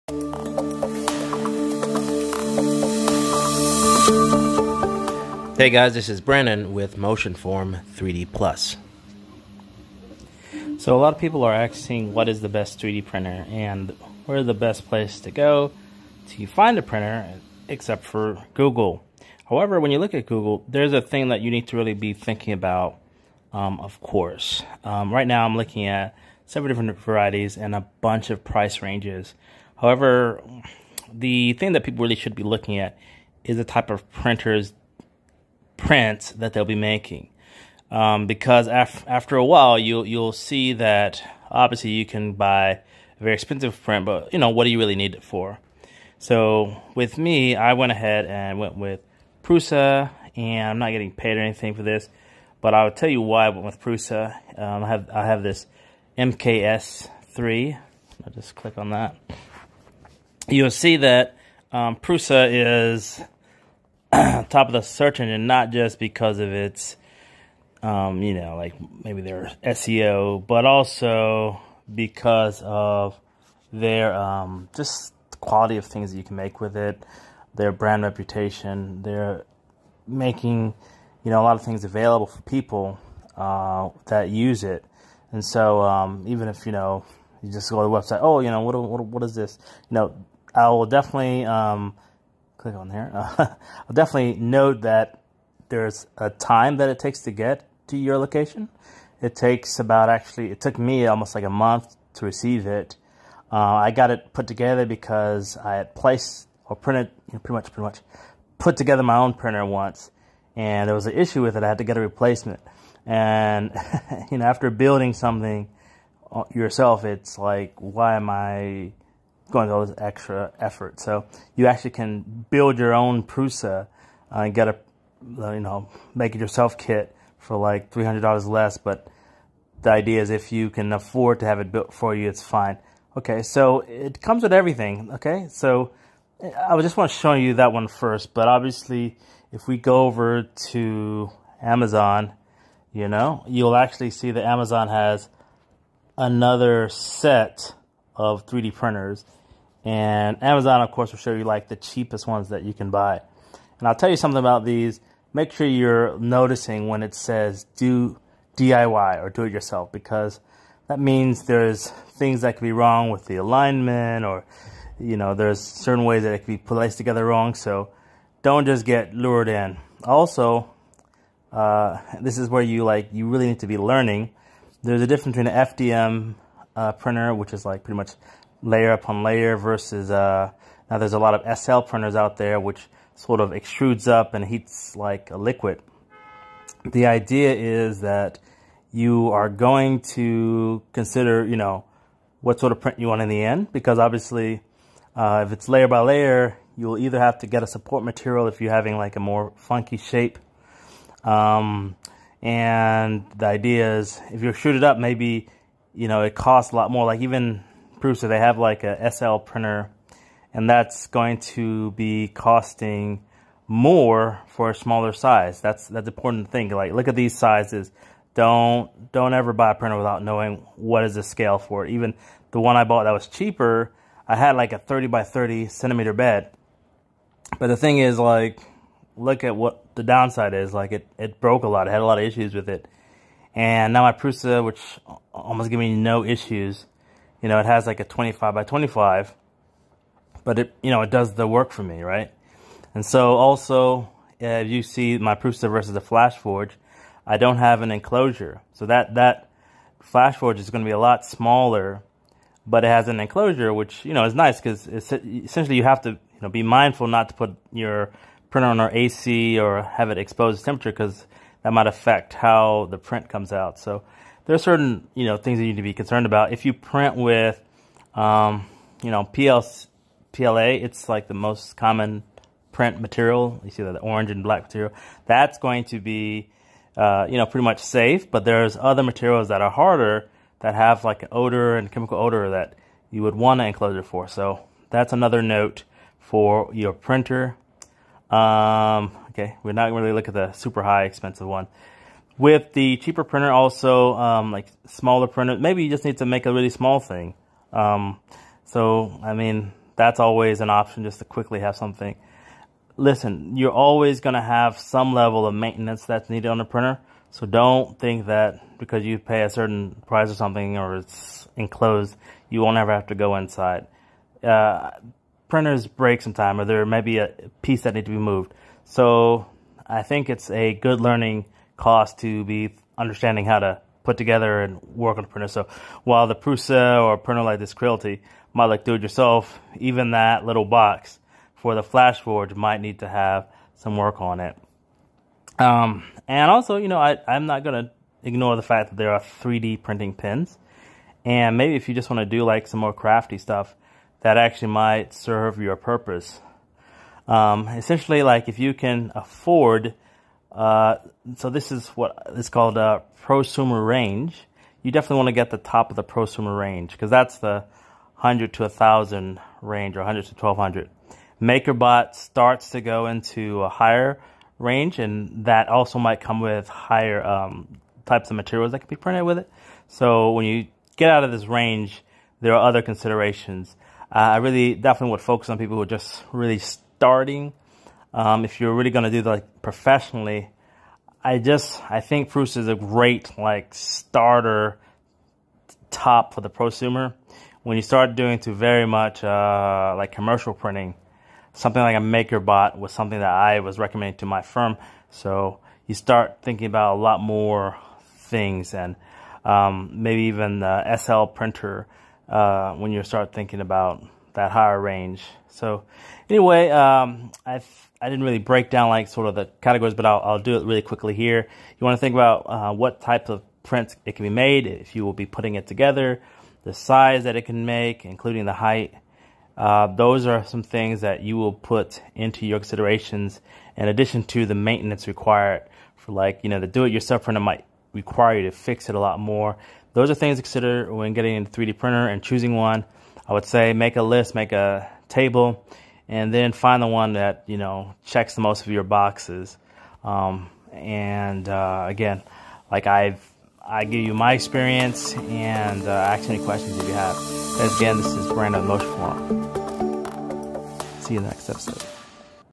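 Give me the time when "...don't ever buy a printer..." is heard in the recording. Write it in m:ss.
3:39.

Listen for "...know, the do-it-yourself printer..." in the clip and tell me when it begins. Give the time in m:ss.
7:06.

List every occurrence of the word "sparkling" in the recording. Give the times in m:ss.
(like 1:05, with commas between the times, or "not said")
not said.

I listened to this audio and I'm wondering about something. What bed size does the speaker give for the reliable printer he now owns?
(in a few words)
25 by 25.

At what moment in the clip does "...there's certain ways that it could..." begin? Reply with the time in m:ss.
2:45.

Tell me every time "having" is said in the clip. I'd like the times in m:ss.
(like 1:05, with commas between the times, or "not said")
3:18.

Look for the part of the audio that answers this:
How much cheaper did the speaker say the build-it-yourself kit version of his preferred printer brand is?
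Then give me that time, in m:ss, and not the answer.
2:07.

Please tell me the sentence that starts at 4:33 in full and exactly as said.
You see that the orange and black material.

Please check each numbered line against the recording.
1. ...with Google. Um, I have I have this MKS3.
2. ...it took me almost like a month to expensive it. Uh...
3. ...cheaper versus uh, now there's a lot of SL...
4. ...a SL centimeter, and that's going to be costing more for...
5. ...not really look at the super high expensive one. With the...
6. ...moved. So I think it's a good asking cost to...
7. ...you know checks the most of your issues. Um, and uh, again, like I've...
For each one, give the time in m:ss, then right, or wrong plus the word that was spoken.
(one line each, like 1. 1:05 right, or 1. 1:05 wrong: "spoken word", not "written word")
1. 0:53 wrong: "Prusa", not "Google"
2. 1:40 wrong: "receive", not "expensive"
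3. 2:59 wrong: "layer", not "cheaper"
4. 3:28 wrong: "printer", not "centimeter"
5. 4:49 right
6. 5:18 wrong: "learning", not "asking"
7. 7:17 wrong: "boxes", not "issues".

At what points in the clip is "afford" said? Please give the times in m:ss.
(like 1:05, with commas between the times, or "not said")
2:10, 5:49.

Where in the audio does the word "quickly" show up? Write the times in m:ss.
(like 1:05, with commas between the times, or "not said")
5:01, 6:50.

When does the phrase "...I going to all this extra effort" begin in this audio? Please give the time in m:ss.
1:58.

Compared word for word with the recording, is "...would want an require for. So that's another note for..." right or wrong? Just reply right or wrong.
wrong.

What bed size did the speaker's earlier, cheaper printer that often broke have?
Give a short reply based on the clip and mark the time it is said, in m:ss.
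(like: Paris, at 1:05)
30 by 30 cm, at 3:44.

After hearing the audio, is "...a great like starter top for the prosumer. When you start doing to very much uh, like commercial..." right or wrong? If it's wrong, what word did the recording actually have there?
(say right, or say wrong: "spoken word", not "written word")
right.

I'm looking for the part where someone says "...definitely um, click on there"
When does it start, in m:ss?
1:30.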